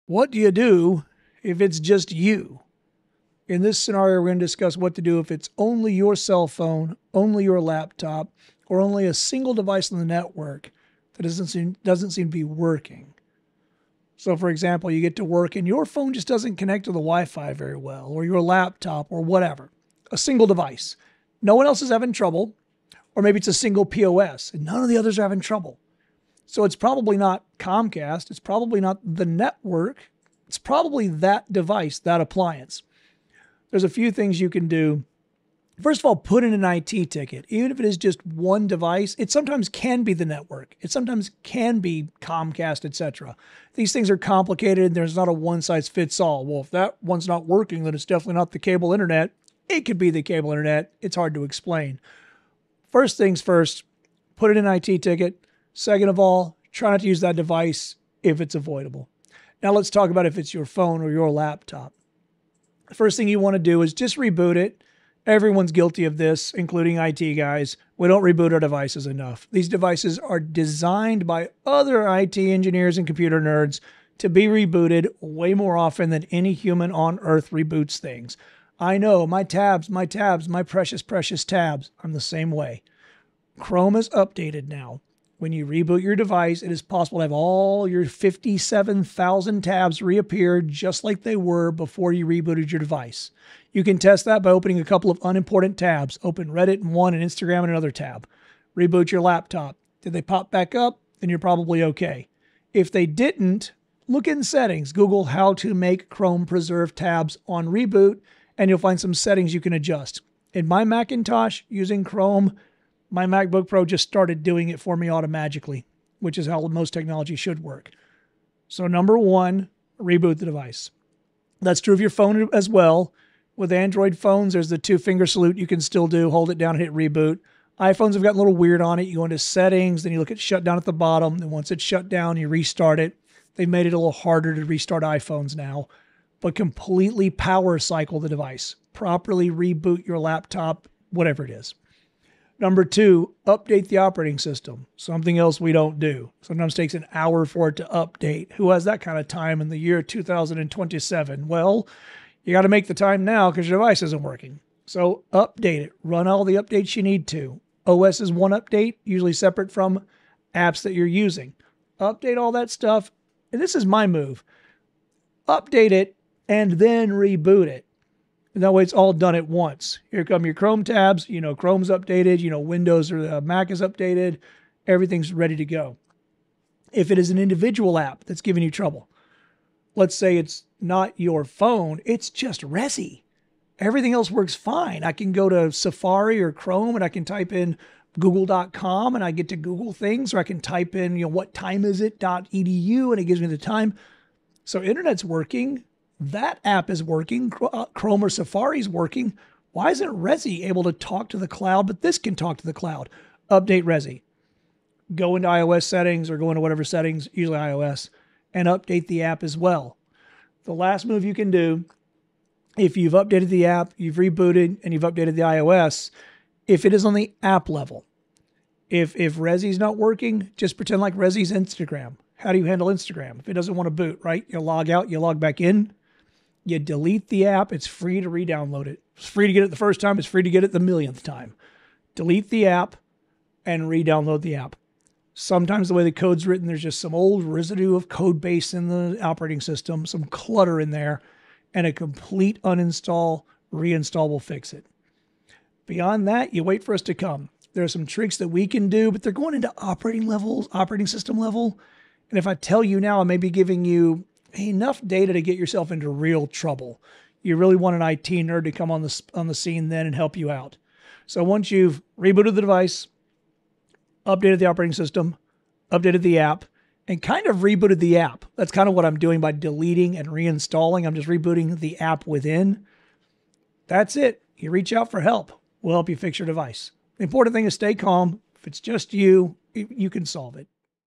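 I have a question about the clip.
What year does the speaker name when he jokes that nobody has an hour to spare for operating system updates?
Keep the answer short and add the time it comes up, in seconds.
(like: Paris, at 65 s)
2027, at 150 s.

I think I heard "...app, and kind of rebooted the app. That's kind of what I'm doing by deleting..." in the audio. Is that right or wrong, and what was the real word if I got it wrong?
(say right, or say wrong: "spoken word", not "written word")
right.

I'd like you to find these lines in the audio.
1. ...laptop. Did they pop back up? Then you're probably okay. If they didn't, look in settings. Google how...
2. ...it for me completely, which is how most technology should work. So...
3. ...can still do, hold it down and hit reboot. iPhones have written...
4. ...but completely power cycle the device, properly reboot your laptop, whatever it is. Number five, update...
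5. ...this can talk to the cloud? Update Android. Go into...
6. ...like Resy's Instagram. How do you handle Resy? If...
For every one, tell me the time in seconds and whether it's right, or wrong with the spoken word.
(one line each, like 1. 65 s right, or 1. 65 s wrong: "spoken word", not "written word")
1. 99 s right
2. 114 s wrong: "automatically", not "completely"
3. 125 s wrong: "gotten", not "written"
4. 136 s wrong: "two", not "five"
5. 202 s wrong: "Resy", not "Android"
6. 221 s wrong: "Instagram", not "Resy".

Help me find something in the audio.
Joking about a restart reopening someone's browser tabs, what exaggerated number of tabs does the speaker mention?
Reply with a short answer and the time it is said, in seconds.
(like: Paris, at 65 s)
57,000, at 88 s.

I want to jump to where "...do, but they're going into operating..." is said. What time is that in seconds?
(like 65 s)
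248 s.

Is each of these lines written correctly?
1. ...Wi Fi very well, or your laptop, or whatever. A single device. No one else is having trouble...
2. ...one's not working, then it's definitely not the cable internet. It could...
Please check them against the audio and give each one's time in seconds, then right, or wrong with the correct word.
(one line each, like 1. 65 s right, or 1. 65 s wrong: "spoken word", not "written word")
1. 16 s right
2. 47 s right.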